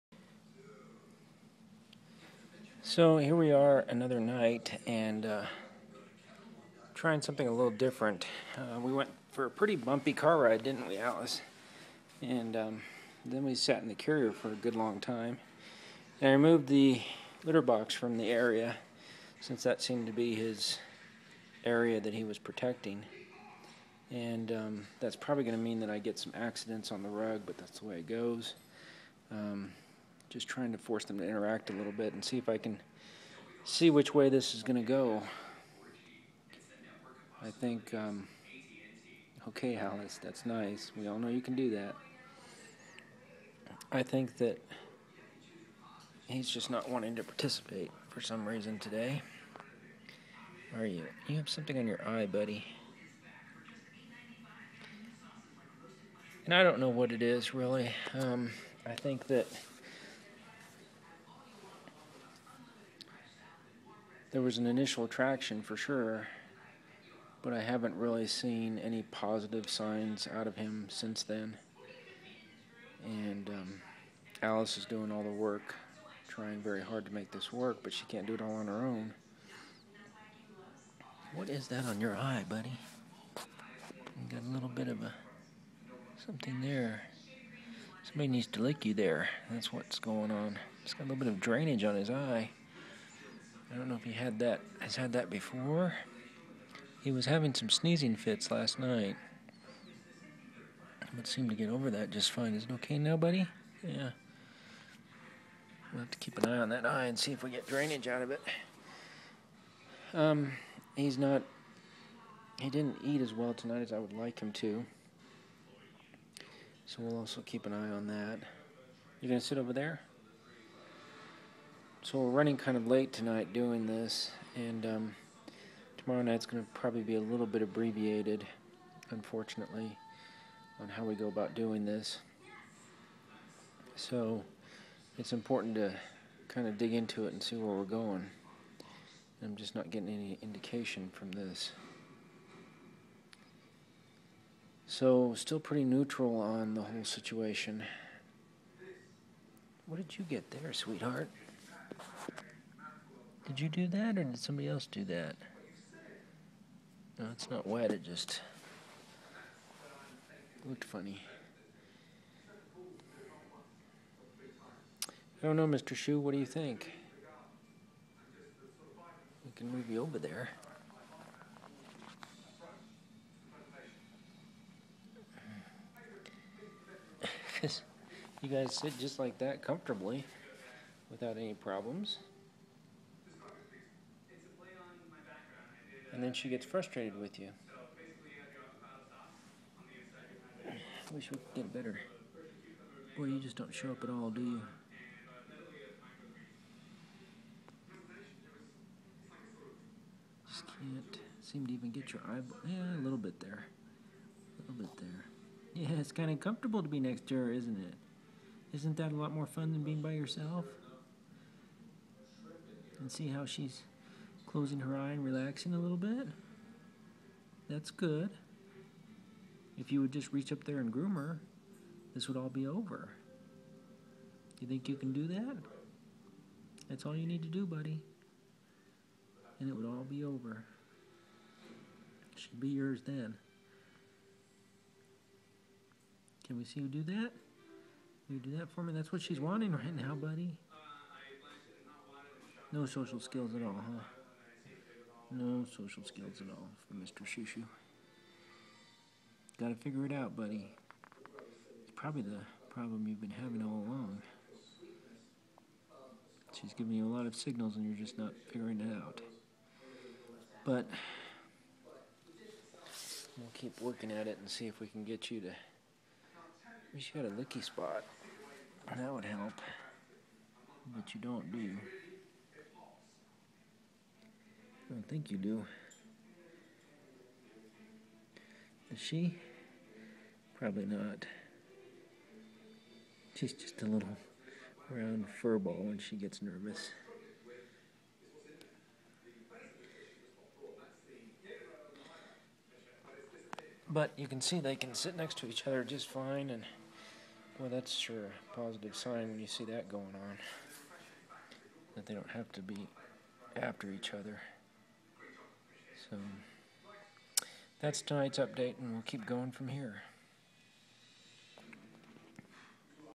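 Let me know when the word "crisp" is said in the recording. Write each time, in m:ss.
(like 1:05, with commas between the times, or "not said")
not said.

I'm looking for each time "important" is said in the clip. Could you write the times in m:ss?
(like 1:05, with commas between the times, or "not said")
2:15.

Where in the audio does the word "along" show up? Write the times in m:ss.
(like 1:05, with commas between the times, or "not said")
4:13.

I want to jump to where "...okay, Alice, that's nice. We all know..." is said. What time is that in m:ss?
0:39.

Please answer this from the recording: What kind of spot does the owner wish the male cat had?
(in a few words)
licky spot.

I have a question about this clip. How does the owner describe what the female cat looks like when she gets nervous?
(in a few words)
little round fur ball.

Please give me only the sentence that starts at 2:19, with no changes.
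I'm just not getting any indication from this.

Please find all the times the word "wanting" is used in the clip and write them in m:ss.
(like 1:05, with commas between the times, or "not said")
0:46, 3:59.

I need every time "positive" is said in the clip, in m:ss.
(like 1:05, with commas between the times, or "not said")
1:09, 4:58.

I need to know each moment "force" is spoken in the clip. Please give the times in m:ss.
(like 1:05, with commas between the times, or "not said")
0:30.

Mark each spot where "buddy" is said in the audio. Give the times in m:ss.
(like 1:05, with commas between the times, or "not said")
0:52, 1:22, 1:43, 3:47, 4:00, 4:10.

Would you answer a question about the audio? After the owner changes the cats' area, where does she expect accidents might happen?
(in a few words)
rug.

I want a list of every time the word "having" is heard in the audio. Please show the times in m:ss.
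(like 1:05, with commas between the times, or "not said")
1:37, 4:13.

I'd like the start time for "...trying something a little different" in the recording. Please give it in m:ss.
0:06.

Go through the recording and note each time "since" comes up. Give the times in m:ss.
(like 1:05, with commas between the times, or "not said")
0:19, 1:10.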